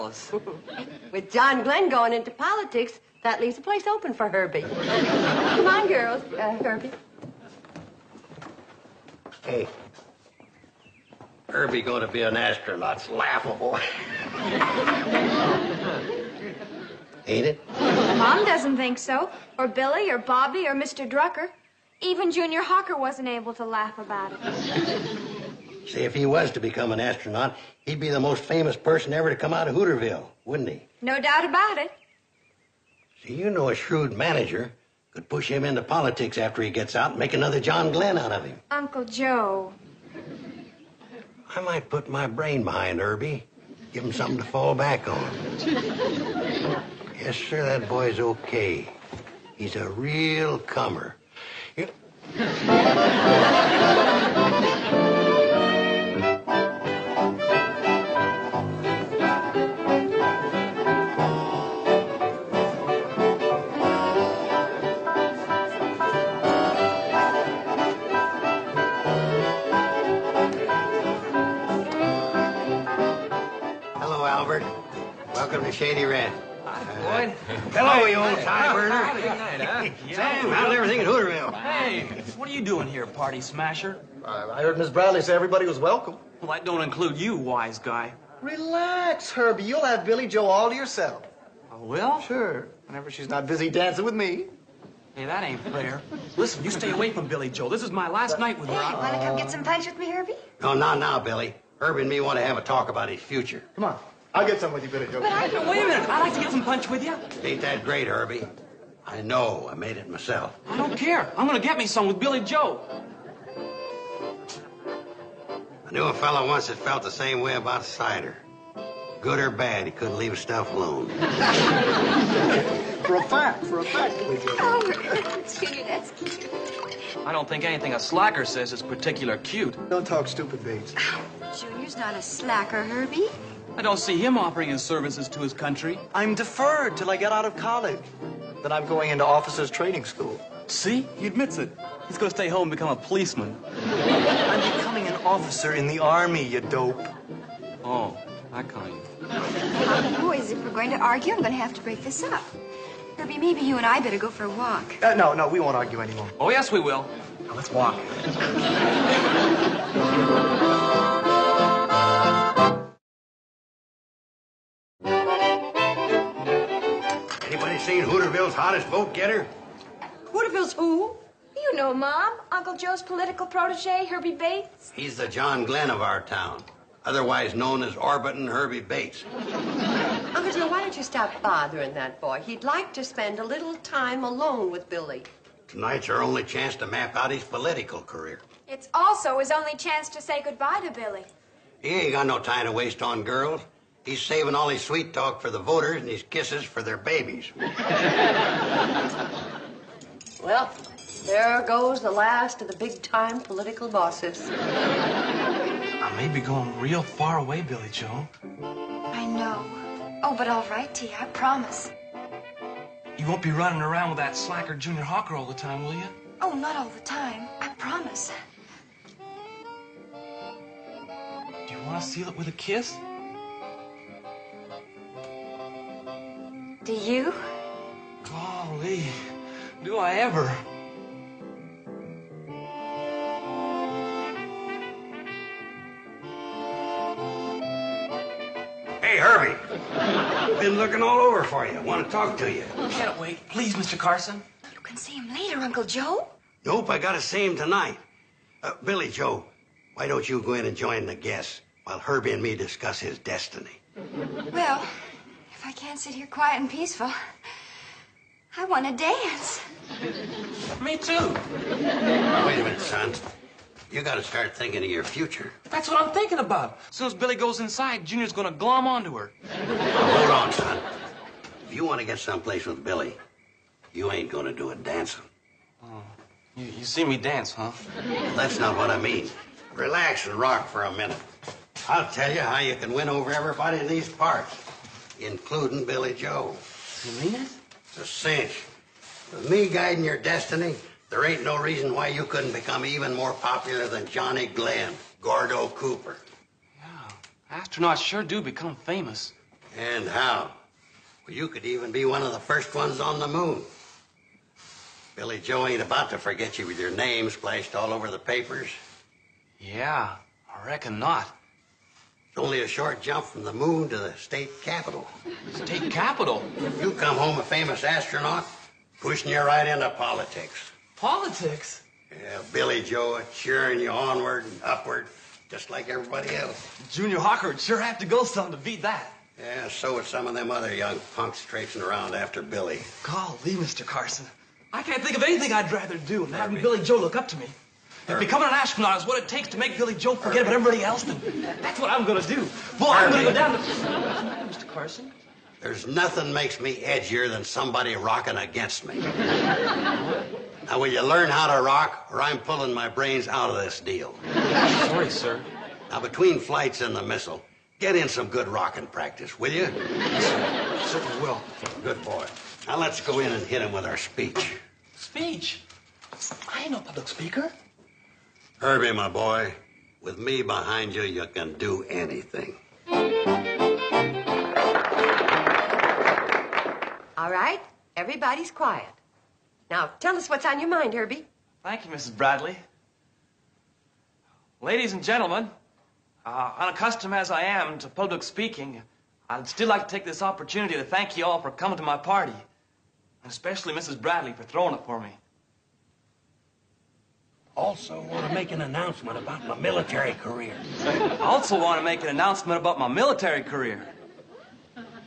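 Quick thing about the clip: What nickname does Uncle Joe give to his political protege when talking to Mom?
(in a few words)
Orbitin' Herby Bates.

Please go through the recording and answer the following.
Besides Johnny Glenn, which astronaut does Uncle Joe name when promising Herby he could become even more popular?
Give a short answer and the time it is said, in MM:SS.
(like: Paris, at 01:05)
Gordo Cooper, at 04:55.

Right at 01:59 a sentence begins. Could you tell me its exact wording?
Good or bad, he couldn't leave stuff alone.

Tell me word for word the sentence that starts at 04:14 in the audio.
Well, can't sit here quiet and peaceful.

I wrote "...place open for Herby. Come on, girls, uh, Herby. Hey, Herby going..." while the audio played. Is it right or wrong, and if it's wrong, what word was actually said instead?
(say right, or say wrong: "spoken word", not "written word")
right.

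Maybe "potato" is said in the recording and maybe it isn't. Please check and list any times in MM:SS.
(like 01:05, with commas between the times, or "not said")
not said.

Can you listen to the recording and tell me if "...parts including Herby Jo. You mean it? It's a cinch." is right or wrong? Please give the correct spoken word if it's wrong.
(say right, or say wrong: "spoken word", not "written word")
wrong: "Billie", not "Herby".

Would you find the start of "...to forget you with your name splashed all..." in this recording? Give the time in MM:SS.
05:06.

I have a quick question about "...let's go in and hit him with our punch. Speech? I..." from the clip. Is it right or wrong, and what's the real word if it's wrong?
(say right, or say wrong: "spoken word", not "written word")
wrong: "speech", not "punch".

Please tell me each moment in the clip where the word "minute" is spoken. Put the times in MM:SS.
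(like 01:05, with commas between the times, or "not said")
01:45, 04:22, 04:40.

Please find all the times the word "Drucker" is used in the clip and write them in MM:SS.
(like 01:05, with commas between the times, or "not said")
00:21.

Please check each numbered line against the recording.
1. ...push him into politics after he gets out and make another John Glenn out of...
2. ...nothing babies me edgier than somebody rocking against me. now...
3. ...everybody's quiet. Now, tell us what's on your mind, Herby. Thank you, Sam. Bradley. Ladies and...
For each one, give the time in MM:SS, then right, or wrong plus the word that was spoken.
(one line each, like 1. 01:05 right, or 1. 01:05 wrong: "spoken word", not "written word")
1. 00:35 right
2. 05:45 wrong: "makes", not "babies"
3. 06:17 wrong: "Mrs", not "Sam".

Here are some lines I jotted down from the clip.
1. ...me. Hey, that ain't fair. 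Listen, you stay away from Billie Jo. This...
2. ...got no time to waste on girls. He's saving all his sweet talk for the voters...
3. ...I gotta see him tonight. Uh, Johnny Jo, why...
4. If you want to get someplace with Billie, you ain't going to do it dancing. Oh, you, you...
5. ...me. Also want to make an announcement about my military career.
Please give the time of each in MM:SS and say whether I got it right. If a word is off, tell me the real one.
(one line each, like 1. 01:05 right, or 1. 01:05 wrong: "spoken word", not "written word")
1. 01:34 right
2. 03:12 right
3. 04:06 wrong: "Billie", not "Johnny"
4. 04:31 right
5. 06:34 right.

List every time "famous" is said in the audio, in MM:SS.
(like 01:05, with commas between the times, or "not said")
00:28, 04:58, 05:17.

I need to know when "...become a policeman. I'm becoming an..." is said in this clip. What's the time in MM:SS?
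02:22.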